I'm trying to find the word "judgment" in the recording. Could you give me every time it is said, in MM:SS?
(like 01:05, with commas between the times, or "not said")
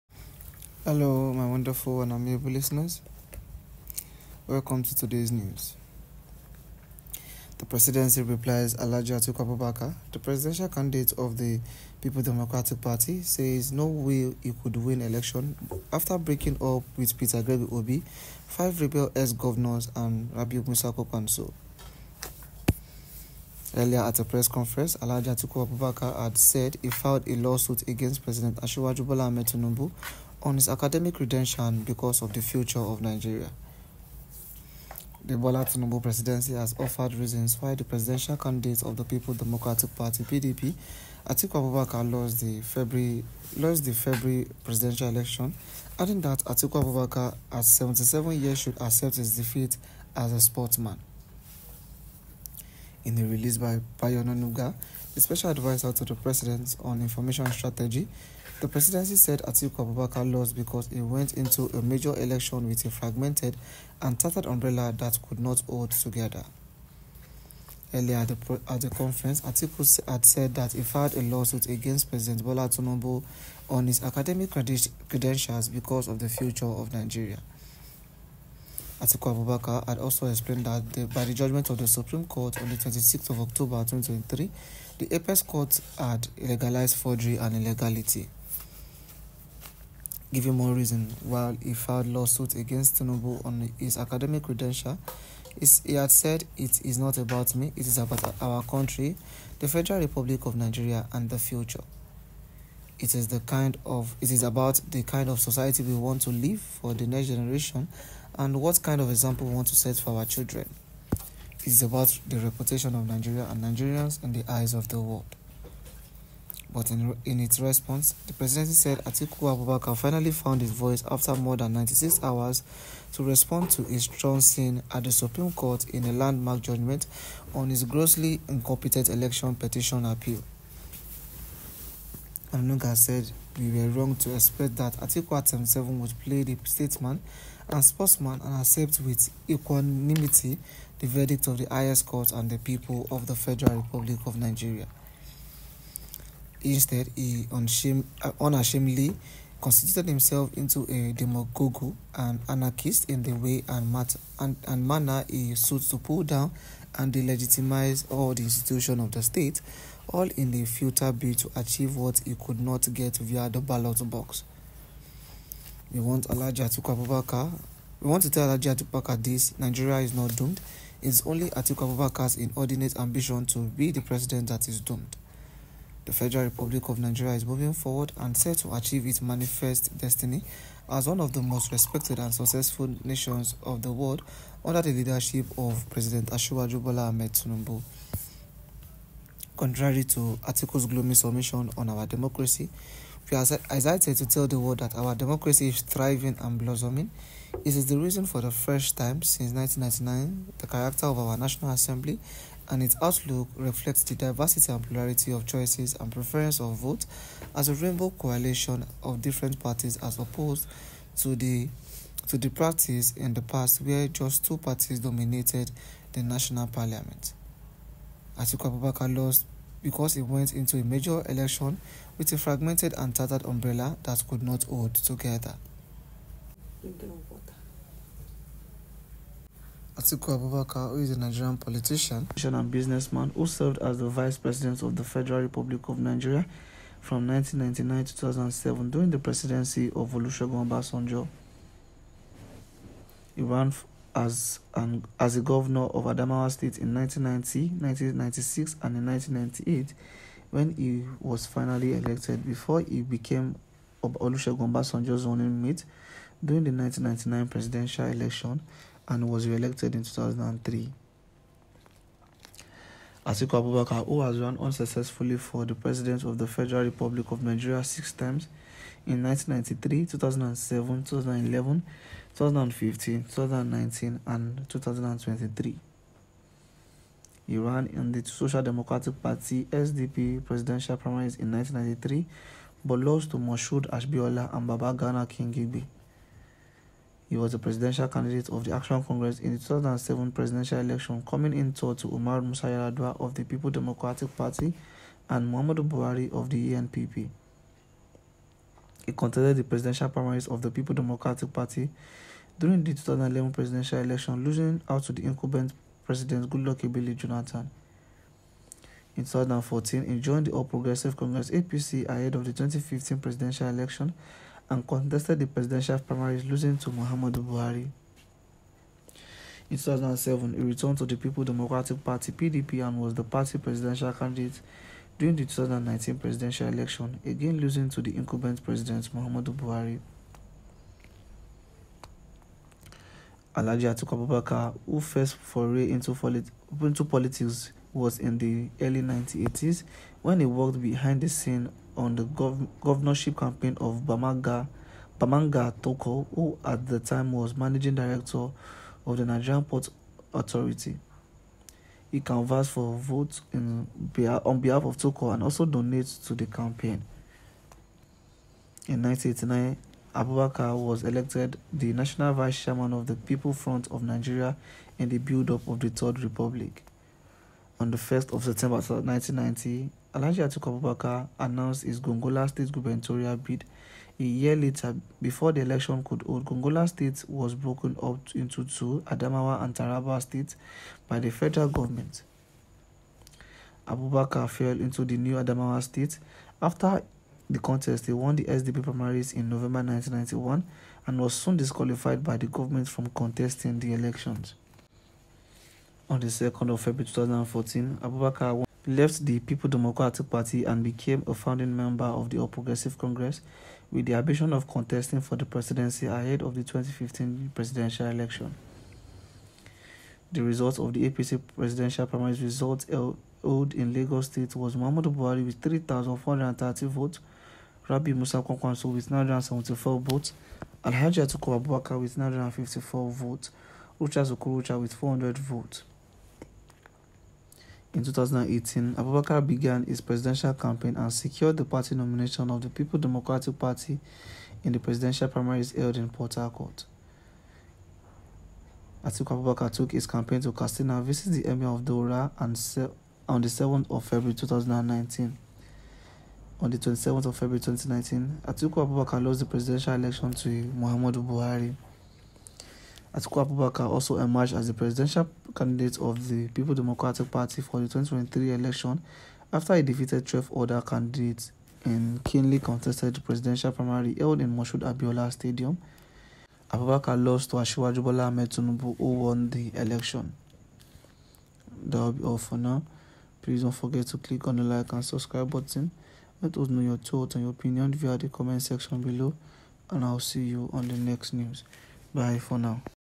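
01:21, 02:06.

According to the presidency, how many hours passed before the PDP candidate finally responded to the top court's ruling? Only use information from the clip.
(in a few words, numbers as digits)
96.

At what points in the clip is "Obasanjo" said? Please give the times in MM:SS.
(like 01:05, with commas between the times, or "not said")
04:00, 04:14.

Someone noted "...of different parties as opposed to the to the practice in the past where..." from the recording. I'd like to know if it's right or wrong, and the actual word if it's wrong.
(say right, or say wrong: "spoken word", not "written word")
right.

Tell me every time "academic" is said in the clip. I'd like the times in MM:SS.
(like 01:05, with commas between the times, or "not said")
00:30, 01:14, 01:33.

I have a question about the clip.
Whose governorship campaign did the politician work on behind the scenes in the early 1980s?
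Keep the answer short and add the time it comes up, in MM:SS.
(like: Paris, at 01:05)
Bamanga Tukur, at 05:45.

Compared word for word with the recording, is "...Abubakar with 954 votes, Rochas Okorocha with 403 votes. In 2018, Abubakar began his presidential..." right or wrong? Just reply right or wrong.
wrong.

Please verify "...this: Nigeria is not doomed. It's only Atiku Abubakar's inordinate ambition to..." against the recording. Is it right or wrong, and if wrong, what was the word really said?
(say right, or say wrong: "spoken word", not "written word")
right.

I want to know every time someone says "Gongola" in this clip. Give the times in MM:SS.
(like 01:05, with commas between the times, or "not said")
06:12, 06:16.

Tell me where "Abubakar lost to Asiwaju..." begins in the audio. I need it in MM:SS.
07:46.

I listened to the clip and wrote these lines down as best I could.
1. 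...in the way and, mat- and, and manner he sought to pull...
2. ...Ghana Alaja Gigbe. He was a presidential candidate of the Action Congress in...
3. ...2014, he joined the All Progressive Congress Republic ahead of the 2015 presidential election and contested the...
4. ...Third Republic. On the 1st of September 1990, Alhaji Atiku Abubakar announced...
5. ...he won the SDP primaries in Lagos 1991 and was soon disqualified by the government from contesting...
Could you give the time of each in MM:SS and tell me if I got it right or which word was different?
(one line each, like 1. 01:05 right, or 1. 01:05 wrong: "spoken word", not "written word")
1. 02:33 right
2. 04:44 wrong: "King", not "Alaja"
3. 05:09 wrong: "APC", not "Republic"
4. 06:05 right
5. 06:28 wrong: "November", not "Lagos".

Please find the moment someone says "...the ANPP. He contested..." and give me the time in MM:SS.
04:56.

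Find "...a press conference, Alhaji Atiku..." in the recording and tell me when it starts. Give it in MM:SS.
00:24.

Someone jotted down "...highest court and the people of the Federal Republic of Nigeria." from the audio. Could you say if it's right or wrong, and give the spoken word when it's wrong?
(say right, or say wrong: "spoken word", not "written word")
right.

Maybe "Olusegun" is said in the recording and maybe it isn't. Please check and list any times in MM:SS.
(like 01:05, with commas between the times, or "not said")
04:00, 04:14.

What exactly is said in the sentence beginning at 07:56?
Let us know your thoughts and your opinion via the comment section below and I'll see you on the next news.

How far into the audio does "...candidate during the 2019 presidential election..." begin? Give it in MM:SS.
05:24.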